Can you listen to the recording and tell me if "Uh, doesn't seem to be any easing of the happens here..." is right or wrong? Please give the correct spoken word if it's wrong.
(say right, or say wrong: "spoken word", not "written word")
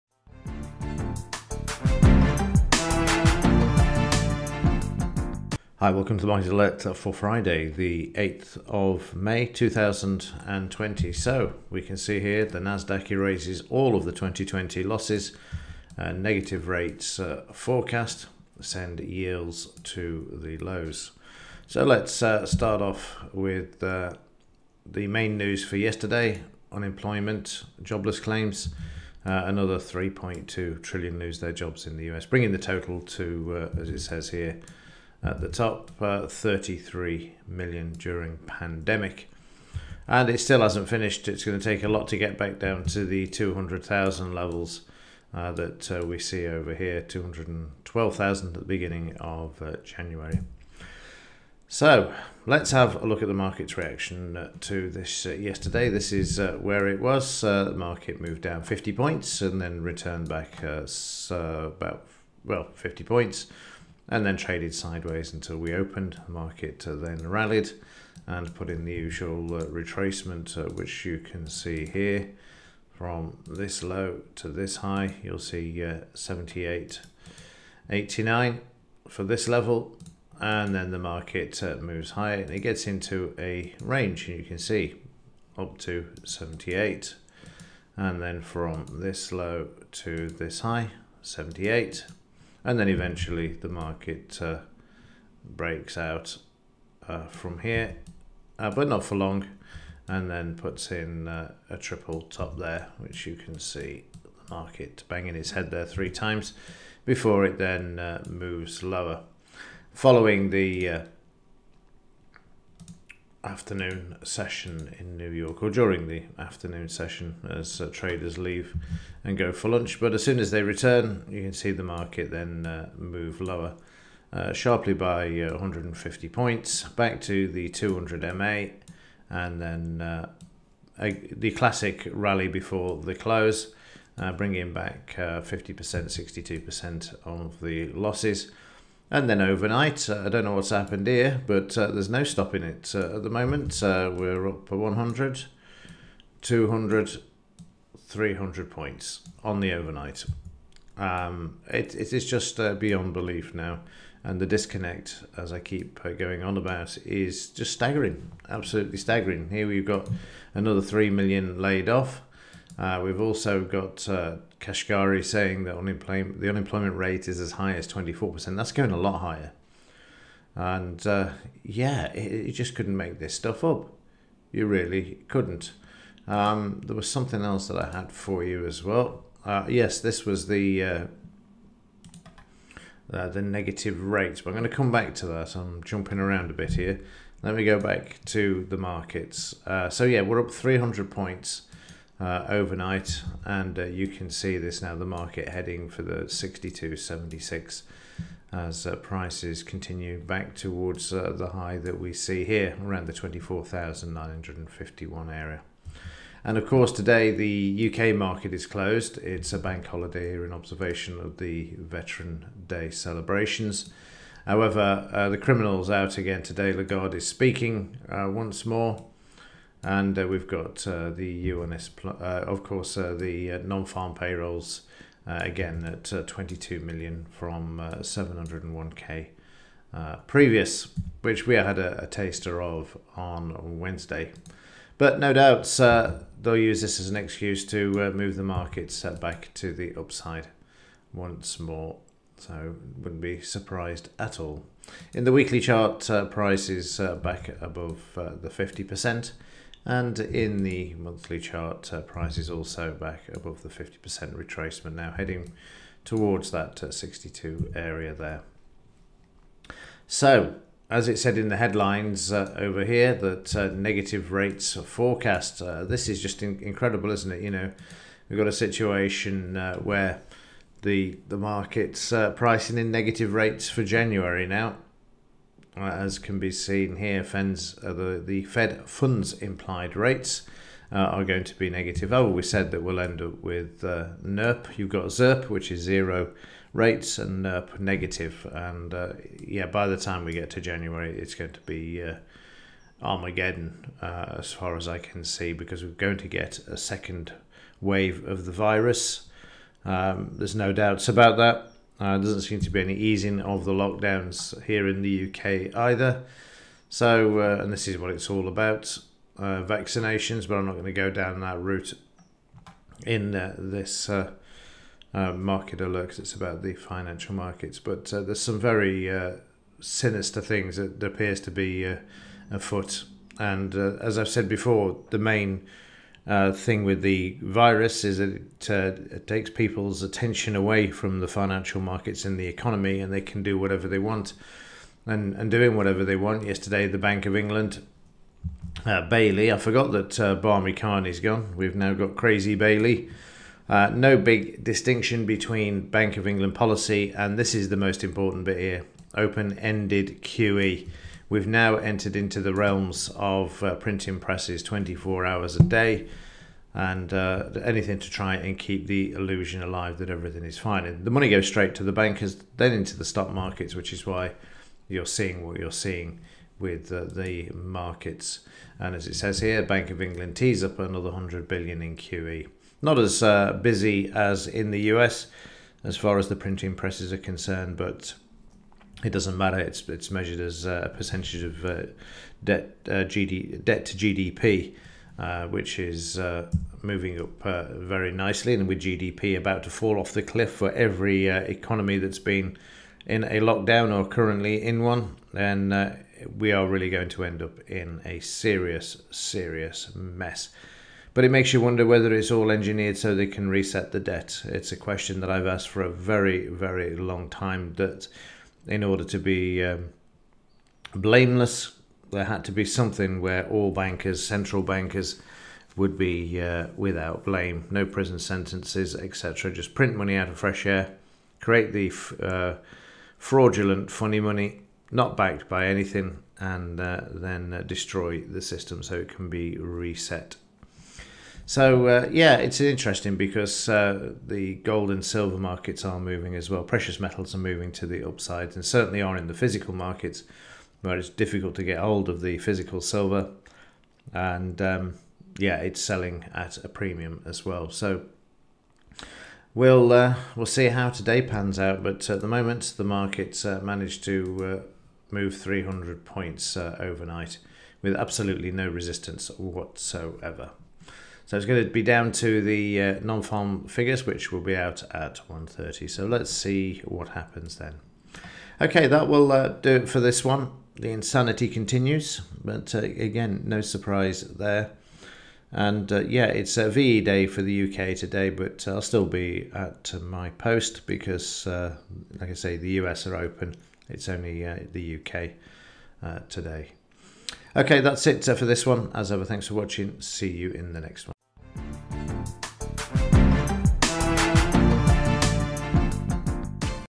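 wrong: "lockdowns", not "happens".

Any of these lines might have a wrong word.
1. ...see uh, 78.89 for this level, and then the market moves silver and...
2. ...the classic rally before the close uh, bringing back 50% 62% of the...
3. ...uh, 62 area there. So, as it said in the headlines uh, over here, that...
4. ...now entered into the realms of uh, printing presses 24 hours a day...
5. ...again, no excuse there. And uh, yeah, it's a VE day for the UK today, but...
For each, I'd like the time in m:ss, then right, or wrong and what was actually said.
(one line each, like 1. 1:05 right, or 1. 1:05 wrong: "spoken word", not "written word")
1. 1:15 wrong: "higher", not "silver"
2. 2:11 right
3. 4:16 right
4. 5:51 right
5. 7:52 wrong: "surprise", not "excuse".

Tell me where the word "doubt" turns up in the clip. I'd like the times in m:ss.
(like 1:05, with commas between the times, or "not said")
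3:55, 5:00.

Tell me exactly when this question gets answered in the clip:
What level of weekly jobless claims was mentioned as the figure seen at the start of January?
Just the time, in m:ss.
0:47.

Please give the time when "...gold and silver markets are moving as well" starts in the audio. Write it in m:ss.
7:14.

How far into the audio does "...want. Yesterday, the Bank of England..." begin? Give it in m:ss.
5:36.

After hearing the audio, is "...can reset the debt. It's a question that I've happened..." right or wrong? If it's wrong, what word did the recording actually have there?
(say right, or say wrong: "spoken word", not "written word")
wrong: "asked", not "happened".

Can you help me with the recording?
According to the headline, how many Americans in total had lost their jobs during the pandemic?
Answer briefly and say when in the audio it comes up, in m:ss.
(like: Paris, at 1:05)
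33 million, at 0:36.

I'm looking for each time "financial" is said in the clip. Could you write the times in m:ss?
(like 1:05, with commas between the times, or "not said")
5:16, 5:31.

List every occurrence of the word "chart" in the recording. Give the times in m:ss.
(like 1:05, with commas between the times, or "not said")
4:05, 4:11.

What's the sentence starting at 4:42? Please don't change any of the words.
Oh, we said that we'll end up with NIRP.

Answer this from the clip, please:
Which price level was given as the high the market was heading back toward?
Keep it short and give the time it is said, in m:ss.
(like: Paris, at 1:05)
24,951, at 3:23.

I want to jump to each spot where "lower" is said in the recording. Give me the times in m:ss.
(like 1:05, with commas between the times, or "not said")
1:48, 2:03.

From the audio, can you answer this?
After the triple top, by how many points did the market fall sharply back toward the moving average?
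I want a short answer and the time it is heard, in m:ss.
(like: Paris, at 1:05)
150, at 2:05.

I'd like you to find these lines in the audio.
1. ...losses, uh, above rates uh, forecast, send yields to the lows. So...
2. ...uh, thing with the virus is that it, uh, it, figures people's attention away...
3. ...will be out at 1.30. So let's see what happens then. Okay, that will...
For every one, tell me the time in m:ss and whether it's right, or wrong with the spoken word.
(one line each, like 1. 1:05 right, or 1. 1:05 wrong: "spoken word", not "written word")
1. 0:14 wrong: "negative", not "above"
2. 5:26 wrong: "takes", not "figures"
3. 7:44 right.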